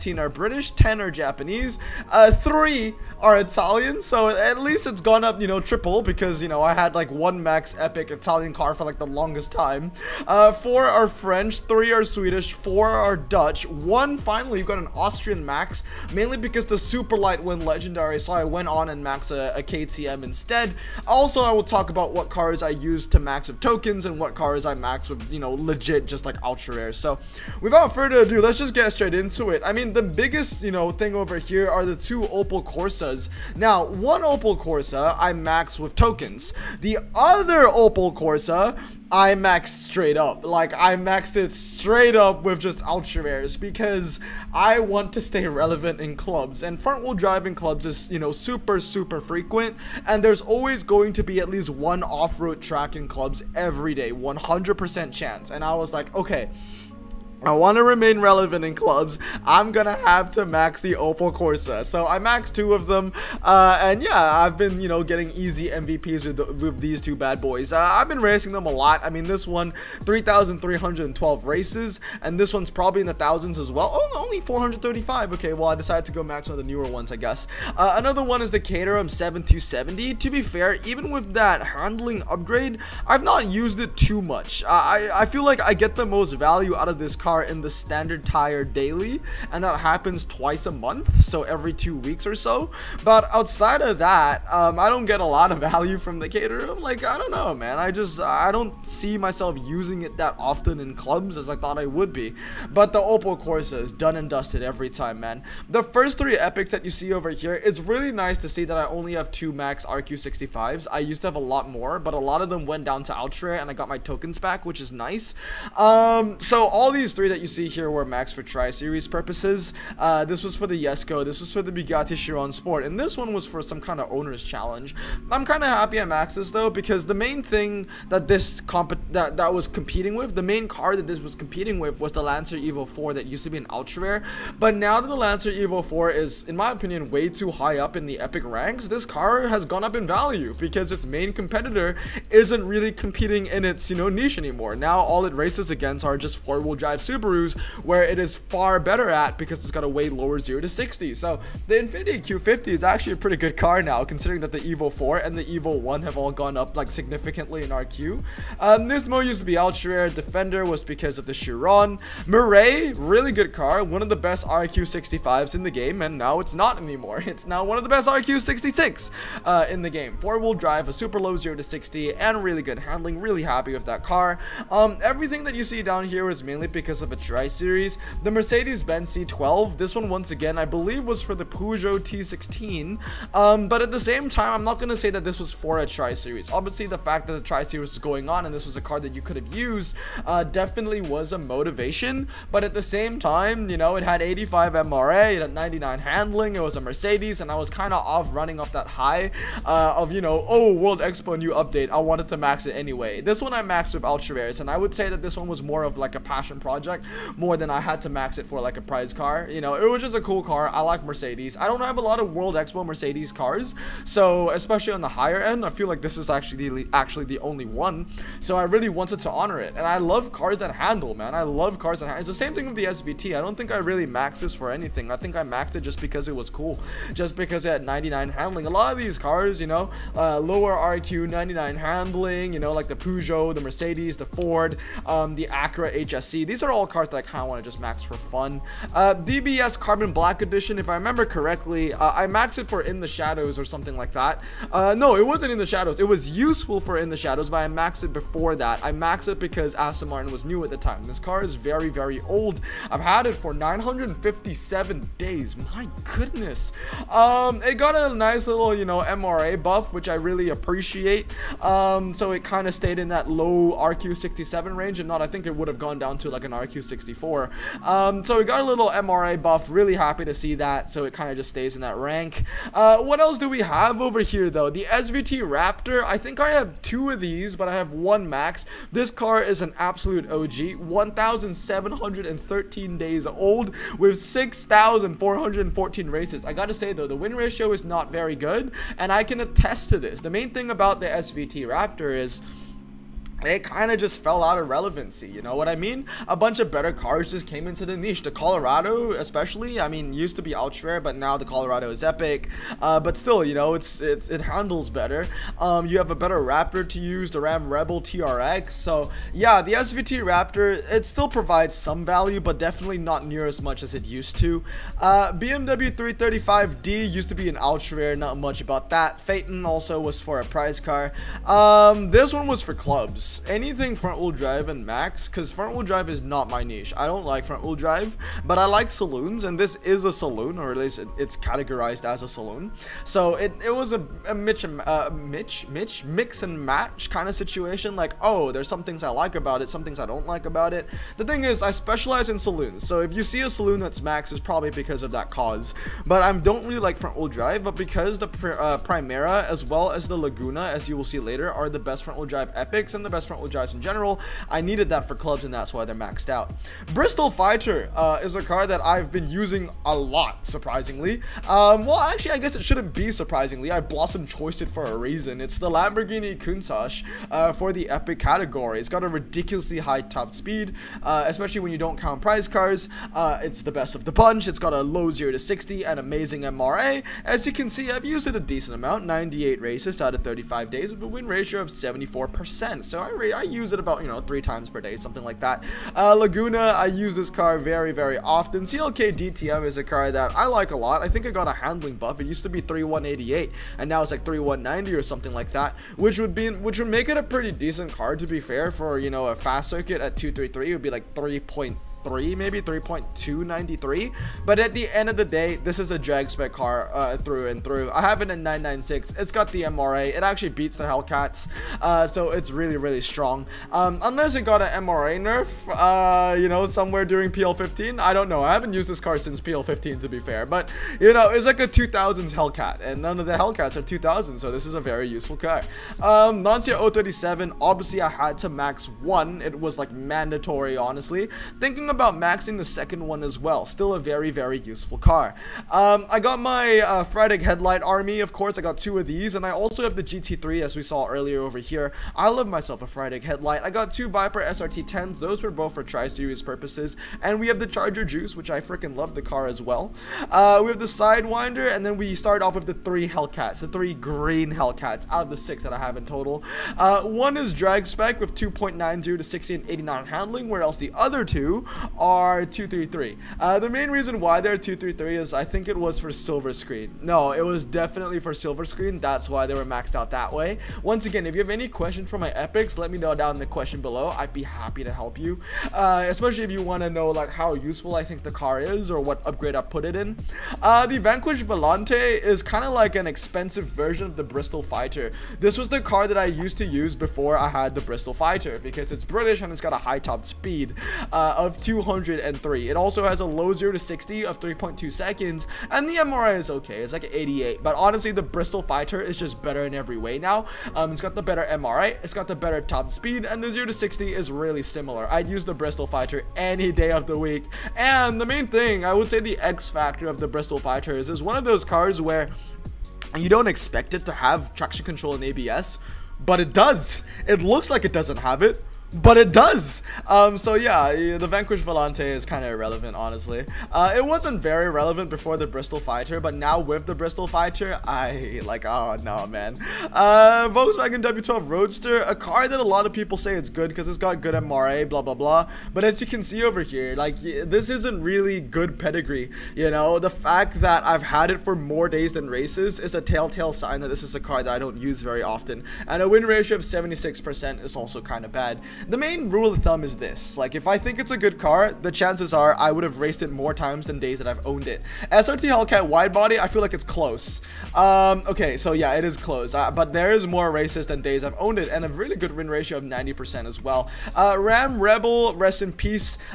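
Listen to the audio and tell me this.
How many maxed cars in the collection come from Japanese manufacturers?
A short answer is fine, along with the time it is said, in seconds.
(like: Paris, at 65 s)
10, at 0 s.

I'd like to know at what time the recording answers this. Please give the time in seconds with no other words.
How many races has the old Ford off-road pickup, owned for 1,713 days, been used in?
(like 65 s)
284 s.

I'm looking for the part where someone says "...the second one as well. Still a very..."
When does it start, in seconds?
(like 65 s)
432 s.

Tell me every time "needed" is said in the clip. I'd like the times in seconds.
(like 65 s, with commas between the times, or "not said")
354 s.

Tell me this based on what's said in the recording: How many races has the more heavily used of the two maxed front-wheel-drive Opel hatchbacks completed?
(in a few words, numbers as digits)
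3,312.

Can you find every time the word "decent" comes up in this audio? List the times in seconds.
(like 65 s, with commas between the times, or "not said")
378 s, 397 s.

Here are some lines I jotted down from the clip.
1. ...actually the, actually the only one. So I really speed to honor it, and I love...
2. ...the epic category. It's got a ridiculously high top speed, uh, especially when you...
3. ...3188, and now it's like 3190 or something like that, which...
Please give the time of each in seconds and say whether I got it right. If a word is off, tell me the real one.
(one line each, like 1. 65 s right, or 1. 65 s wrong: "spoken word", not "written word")
1. 216 s wrong: "wanted", not "speed"
2. 367 s right
3. 392 s right.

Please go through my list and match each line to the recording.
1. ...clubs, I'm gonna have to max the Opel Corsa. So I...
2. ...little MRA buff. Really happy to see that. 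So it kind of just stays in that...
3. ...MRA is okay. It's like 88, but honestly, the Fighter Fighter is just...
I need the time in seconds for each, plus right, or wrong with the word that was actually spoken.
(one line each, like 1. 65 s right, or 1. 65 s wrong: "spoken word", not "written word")
1. 58 s right
2. 268 s right
3. 495 s wrong: "Bristol", not "Fighter".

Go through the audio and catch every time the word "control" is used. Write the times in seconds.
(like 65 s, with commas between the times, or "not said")
514 s.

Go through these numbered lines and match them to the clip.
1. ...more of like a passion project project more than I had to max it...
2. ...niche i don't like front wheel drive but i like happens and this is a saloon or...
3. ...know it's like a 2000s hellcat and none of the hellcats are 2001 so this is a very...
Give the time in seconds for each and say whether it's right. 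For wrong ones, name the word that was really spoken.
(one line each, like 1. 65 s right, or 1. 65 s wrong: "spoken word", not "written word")
1. 205 s right
2. 326 s wrong: "saloons", not "happens"
3. 421 s wrong: "2000", not "2001".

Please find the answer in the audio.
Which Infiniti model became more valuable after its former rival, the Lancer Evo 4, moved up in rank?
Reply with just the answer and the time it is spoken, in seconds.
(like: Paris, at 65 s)
Infiniti Q50, at 151 s.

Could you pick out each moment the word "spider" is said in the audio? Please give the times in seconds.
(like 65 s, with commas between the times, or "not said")
not said.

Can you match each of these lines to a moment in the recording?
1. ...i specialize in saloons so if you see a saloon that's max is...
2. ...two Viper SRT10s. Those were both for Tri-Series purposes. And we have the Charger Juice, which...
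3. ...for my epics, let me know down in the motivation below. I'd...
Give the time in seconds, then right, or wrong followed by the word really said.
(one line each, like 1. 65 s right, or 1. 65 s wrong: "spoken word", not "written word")
1. 341 s right
2. 443 s right
3. 472 s wrong: "question", not "motivation".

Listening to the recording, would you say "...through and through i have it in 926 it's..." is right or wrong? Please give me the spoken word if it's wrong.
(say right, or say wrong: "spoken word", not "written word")
wrong: "996", not "926".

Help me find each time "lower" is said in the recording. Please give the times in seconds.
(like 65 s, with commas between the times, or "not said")
150 s, 230 s.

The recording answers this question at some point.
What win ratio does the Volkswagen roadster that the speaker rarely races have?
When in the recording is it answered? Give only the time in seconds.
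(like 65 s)
546 s.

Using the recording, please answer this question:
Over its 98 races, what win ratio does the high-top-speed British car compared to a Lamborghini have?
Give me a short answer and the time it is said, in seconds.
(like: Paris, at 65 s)
74%, at 381 s.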